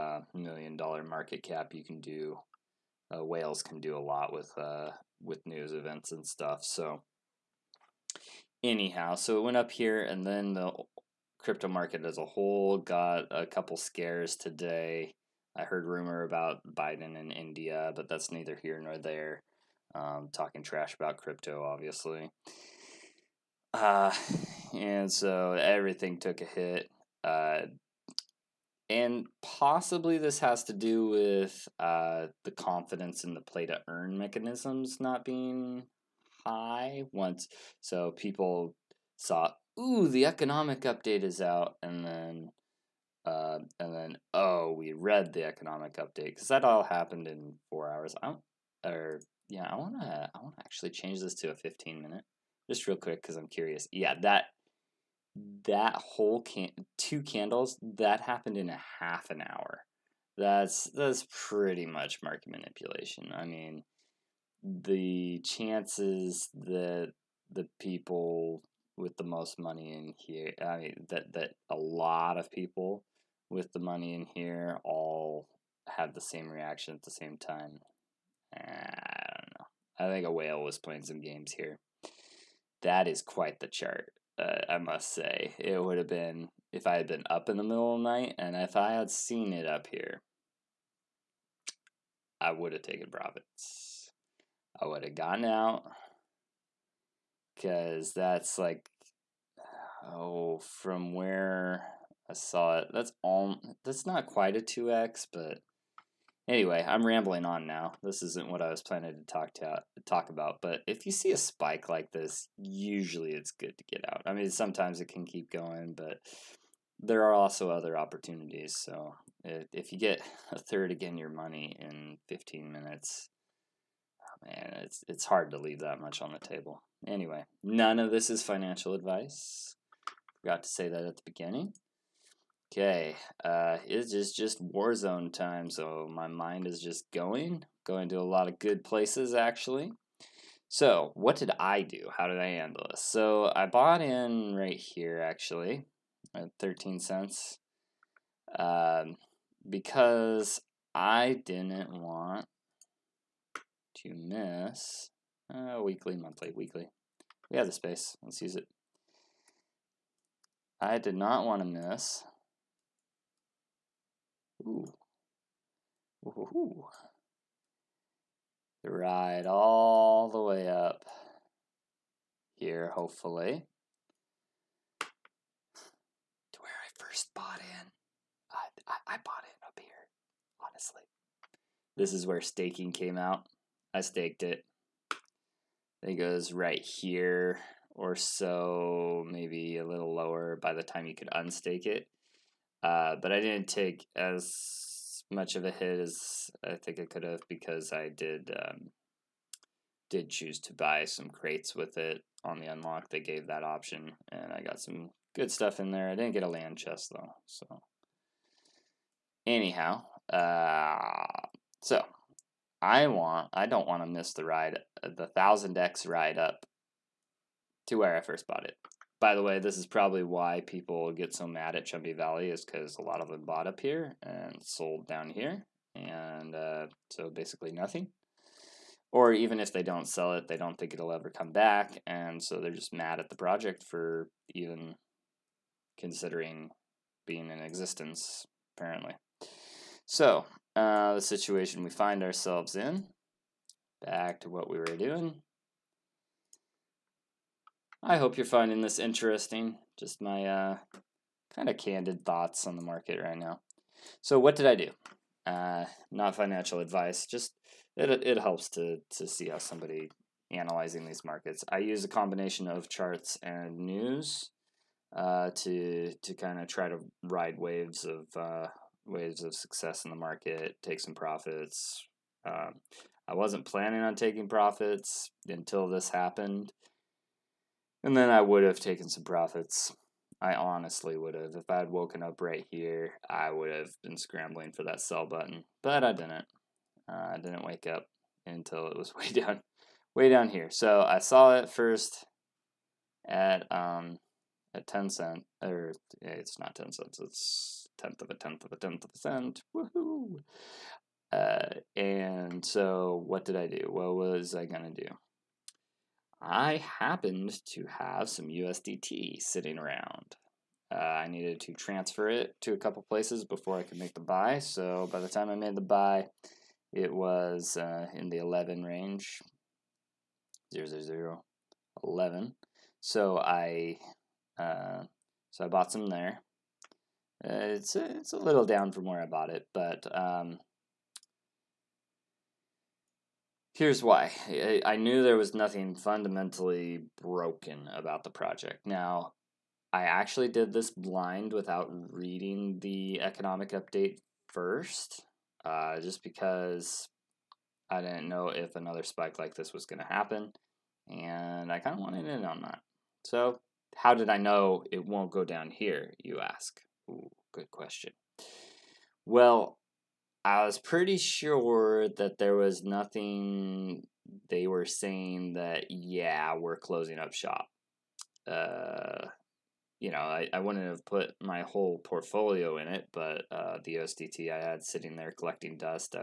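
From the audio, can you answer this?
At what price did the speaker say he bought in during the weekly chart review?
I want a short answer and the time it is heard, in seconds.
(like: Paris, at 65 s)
13 cents, at 146 s.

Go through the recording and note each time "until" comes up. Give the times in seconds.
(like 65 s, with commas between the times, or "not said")
275 s, 288 s.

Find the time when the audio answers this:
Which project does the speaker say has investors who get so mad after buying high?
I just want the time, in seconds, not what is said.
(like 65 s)
221 s.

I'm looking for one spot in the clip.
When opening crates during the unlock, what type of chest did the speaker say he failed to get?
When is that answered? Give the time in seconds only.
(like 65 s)
206 s.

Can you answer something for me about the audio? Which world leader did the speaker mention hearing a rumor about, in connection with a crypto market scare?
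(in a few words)
Biden.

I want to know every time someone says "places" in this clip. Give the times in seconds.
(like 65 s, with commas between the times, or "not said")
138 s, 313 s.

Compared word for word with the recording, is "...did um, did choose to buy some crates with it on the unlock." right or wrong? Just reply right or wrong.
right.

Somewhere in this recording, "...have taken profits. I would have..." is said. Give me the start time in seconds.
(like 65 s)
92 s.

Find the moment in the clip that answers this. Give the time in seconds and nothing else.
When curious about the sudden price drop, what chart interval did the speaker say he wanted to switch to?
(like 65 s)
51 s.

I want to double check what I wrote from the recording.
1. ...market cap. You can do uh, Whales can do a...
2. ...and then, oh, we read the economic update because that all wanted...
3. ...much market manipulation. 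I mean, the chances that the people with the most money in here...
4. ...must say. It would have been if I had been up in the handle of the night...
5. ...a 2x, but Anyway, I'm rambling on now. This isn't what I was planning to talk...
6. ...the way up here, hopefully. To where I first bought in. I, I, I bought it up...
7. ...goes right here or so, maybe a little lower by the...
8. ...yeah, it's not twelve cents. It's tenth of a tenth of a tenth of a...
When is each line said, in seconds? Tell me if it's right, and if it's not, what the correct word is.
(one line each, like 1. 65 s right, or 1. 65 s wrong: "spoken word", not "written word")
1. 1 s right
2. 43 s wrong: "happened", not "wanted"
3. 61 s right
4. 84 s wrong: "middle", not "handle"
5. 104 s right
6. 170 s right
7. 186 s right
8. 296 s wrong: "ten", not "twelve".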